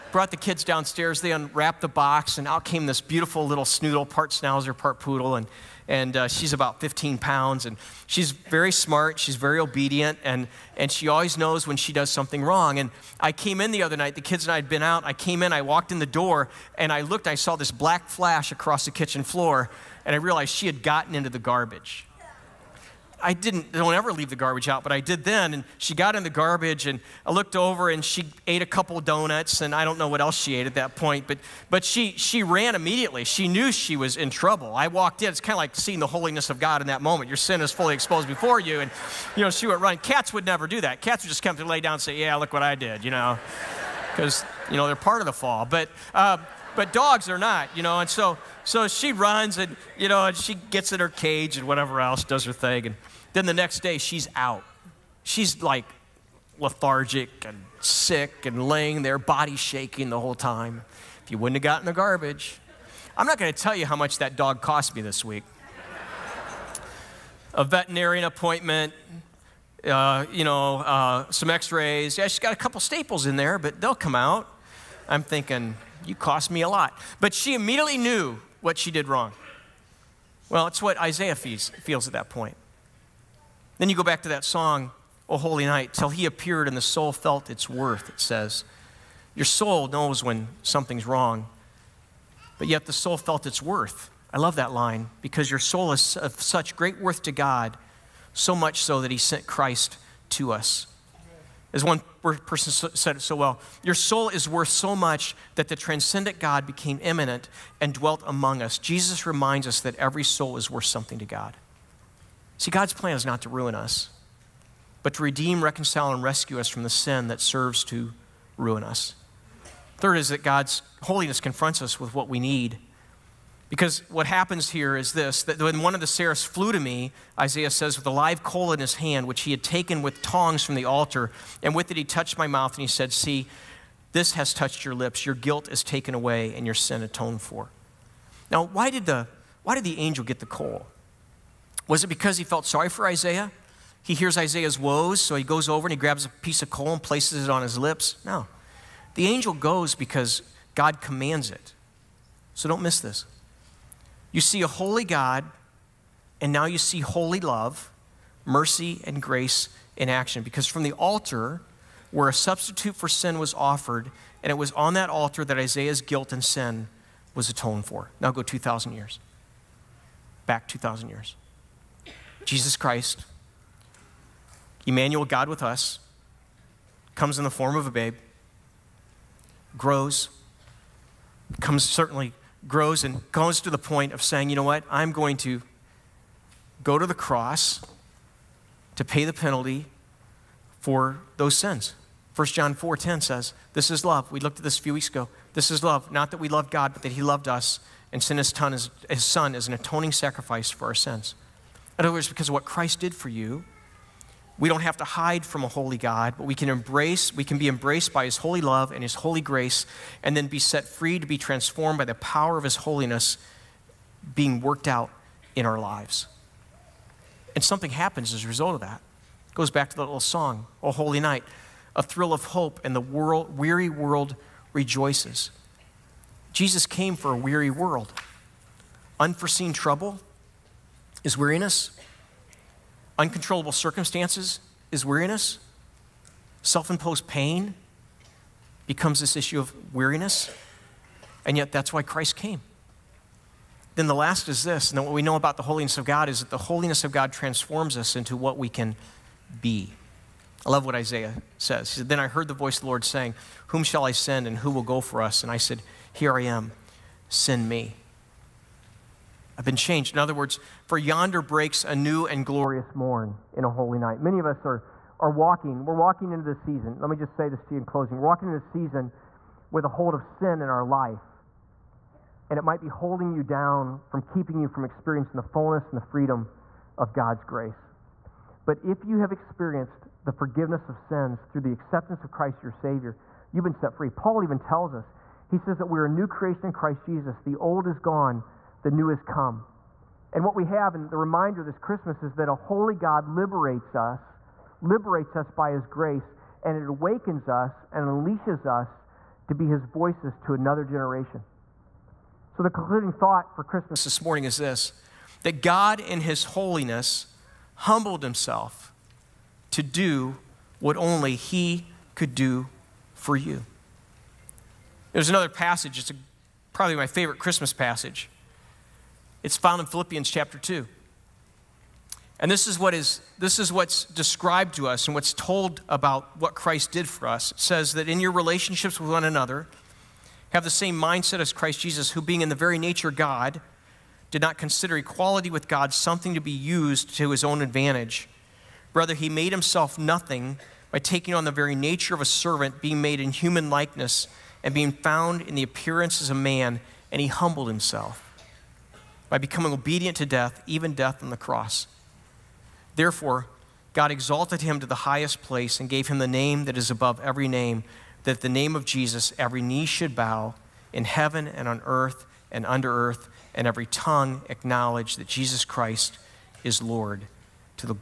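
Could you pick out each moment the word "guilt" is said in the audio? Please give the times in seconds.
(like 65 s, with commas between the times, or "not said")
135 s, 166 s.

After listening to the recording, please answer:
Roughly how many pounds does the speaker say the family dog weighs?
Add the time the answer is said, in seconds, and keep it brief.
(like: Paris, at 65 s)
15, at 6 s.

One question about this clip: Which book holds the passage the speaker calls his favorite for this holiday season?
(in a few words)
Philippians.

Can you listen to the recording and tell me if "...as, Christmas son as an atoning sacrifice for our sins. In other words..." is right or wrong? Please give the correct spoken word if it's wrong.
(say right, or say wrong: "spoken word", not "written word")
wrong: "His", not "Christmas".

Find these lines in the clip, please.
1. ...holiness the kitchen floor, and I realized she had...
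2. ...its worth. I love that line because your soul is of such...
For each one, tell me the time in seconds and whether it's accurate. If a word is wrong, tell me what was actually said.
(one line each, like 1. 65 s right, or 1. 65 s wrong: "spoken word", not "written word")
1. 18 s wrong: "across", not "holiness"
2. 93 s right.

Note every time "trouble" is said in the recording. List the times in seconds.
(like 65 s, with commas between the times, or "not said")
34 s, 229 s.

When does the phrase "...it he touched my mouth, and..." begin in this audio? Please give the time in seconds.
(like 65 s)
131 s.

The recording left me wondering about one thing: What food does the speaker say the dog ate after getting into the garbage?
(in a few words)
donuts.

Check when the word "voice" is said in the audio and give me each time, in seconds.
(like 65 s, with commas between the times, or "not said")
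252 s, 299 s.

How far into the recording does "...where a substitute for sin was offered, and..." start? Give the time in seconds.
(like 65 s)
162 s.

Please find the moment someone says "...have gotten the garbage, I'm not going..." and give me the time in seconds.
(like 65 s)
61 s.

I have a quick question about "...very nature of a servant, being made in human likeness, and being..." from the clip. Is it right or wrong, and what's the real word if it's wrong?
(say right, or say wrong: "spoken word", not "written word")
right.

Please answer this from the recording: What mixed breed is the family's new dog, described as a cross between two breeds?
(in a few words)
schnoodle.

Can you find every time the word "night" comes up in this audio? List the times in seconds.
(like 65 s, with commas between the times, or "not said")
13 s, 85 s, 221 s, 263 s.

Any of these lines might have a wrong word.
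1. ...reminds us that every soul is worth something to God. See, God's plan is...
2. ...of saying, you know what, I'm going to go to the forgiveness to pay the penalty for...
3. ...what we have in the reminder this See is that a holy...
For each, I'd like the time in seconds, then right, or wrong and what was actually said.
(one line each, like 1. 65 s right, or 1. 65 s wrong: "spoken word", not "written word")
1. 109 s right
2. 184 s wrong: "cross", not "forgiveness"
3. 290 s wrong: "Christmas", not "See".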